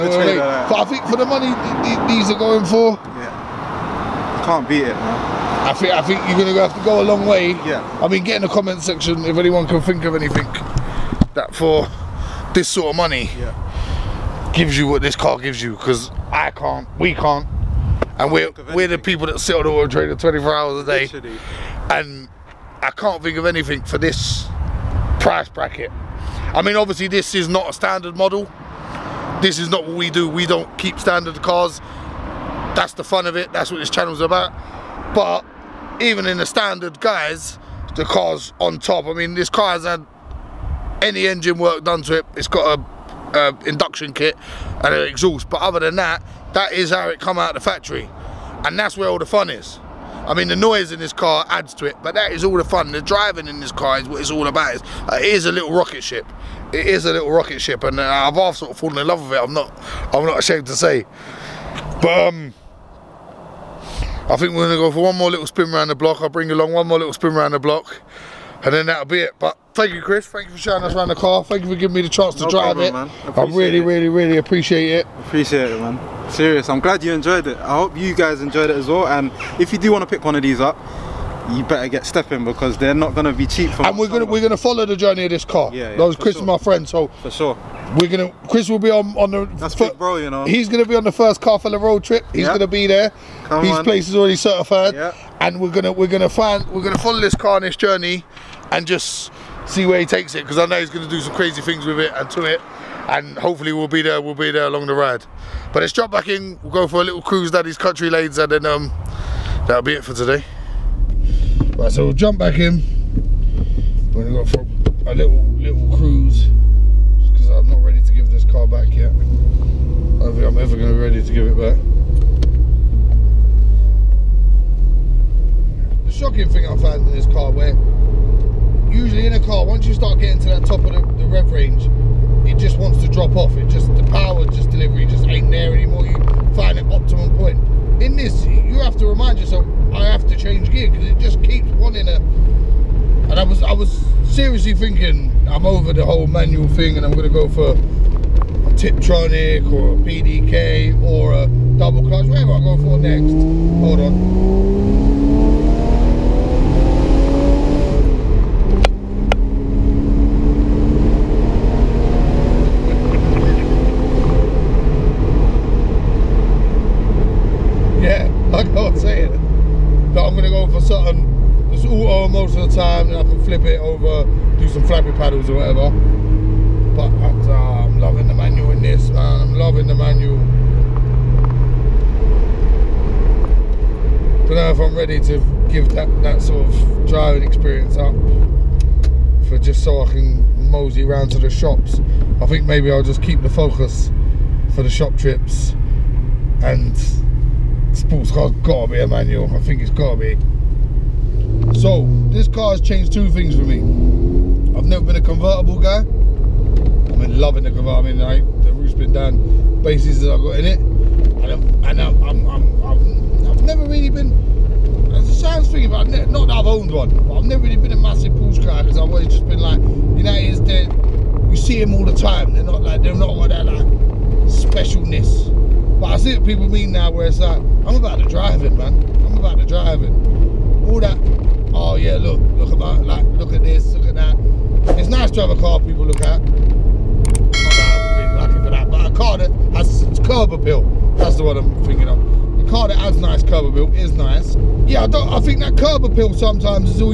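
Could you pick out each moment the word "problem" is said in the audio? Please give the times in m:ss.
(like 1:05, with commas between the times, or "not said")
1:12.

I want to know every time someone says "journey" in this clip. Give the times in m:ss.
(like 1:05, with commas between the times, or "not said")
1:24, 1:37.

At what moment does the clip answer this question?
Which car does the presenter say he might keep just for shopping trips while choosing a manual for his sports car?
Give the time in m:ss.
3:13.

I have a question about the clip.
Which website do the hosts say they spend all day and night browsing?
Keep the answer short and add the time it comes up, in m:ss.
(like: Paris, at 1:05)
Auto Trader, at 0:19.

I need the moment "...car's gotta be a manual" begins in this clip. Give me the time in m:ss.
3:18.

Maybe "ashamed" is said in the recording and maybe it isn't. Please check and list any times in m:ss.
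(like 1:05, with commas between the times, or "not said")
1:00.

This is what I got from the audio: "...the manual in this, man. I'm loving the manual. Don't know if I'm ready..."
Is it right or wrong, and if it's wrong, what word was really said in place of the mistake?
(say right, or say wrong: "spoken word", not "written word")
right.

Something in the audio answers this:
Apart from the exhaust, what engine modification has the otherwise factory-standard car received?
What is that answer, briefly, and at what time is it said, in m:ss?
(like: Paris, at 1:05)
Induction kit, at 0:43.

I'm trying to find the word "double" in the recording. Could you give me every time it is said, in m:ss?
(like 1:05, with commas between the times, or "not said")
2:31.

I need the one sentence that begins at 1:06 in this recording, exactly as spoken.
I'll bring along one more little spin around the block, and then that'll be it.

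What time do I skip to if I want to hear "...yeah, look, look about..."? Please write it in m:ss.
3:51.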